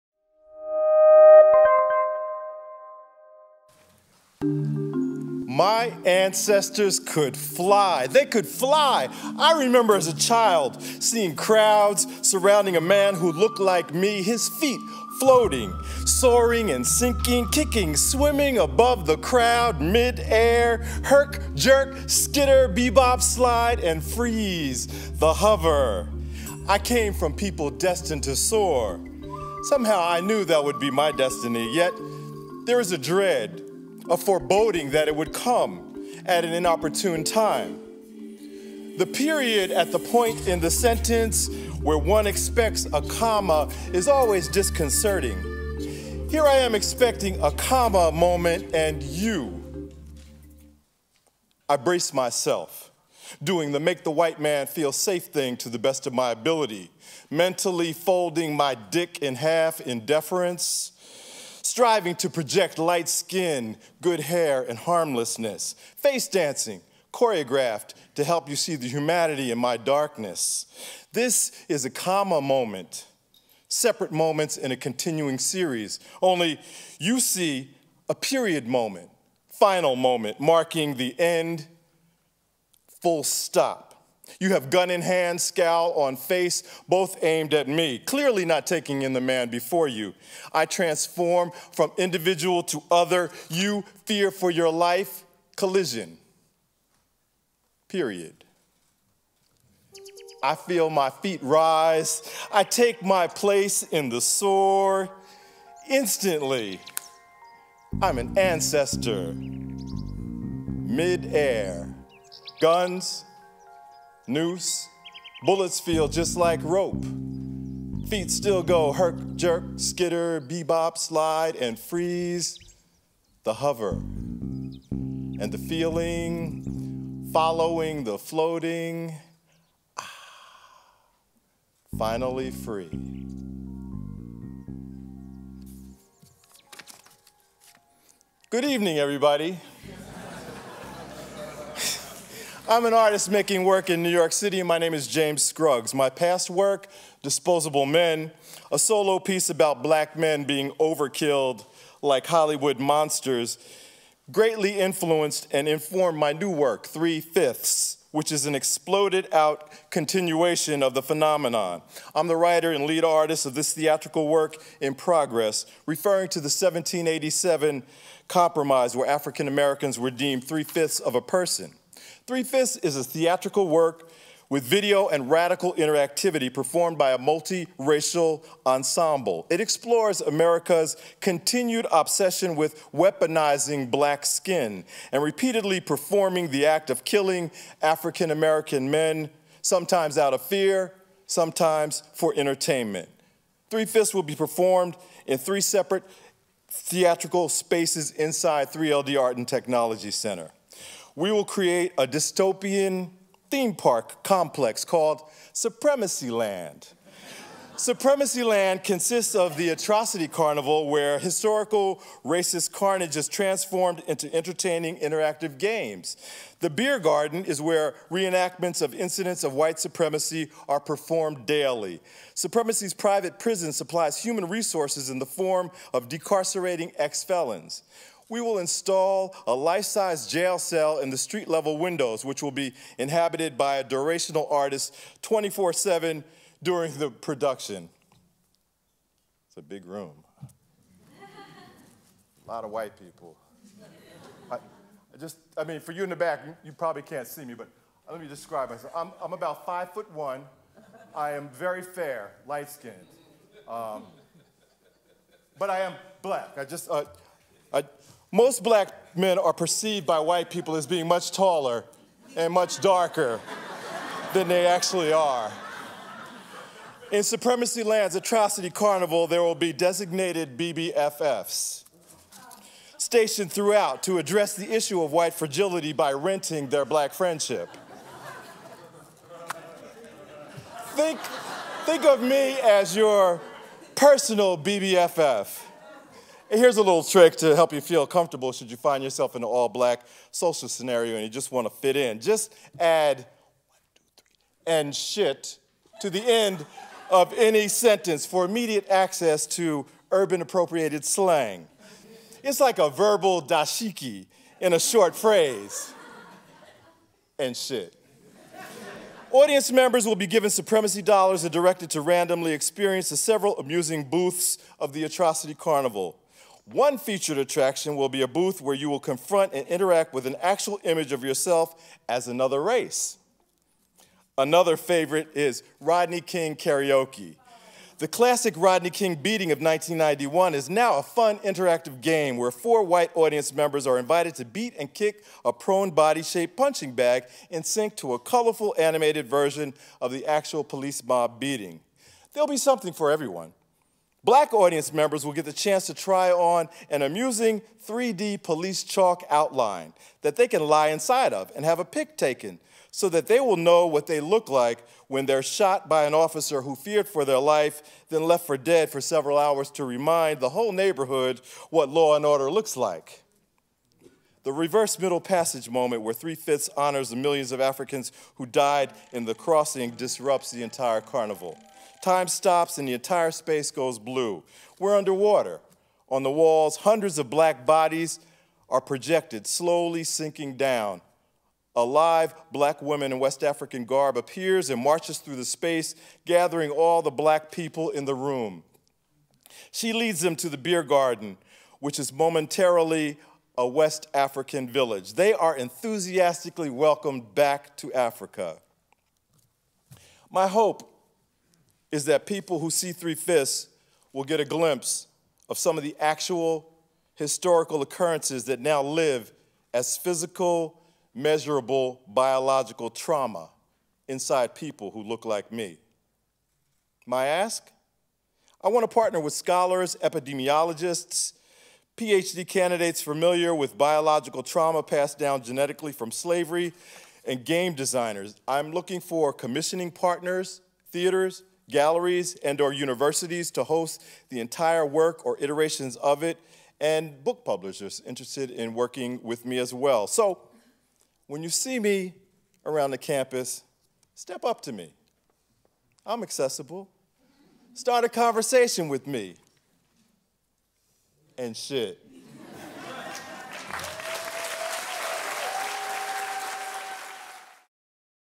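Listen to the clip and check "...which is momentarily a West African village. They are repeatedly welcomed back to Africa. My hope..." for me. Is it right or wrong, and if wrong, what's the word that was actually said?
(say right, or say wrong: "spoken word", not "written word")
wrong: "enthusiastically", not "repeatedly".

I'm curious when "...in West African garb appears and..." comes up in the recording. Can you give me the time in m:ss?
6:23.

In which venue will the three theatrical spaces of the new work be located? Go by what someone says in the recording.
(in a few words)
3LD Art and Technology Center.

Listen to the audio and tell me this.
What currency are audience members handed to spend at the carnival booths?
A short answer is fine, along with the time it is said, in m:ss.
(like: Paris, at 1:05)
supremacy dollars, at 5:10.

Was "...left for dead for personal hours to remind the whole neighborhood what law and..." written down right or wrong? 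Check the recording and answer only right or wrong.
wrong.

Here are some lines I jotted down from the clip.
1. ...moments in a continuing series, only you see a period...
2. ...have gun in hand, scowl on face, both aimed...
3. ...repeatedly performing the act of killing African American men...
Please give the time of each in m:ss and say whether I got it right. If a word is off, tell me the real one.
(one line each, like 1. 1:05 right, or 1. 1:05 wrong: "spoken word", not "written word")
1. 1:14 right
2. 1:24 right
3. 3:05 right.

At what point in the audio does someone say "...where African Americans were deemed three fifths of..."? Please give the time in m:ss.
2:48.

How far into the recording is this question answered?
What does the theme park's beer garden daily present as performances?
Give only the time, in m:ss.
3:38.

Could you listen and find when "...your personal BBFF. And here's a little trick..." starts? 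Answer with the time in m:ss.
4:42.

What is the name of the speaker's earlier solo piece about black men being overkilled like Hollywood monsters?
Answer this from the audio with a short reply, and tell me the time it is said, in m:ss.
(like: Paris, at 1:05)
Disposable Men, at 2:27.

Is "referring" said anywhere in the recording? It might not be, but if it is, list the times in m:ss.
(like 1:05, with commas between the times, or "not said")
2:45.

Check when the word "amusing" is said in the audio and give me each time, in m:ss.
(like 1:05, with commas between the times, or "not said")
5:13, 5:47.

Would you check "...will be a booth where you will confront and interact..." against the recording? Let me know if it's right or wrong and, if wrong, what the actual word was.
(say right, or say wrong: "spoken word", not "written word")
right.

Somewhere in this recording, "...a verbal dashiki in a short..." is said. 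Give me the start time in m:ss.
5:02.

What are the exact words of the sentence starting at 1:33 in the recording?
You fear for your life, collision.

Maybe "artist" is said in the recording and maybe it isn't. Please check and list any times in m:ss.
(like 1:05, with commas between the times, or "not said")
2:22, 2:43, 3:54.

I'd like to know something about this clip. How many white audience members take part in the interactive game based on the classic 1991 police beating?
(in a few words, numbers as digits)
4.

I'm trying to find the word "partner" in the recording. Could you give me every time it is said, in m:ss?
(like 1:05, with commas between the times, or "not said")
6:58, 7:09.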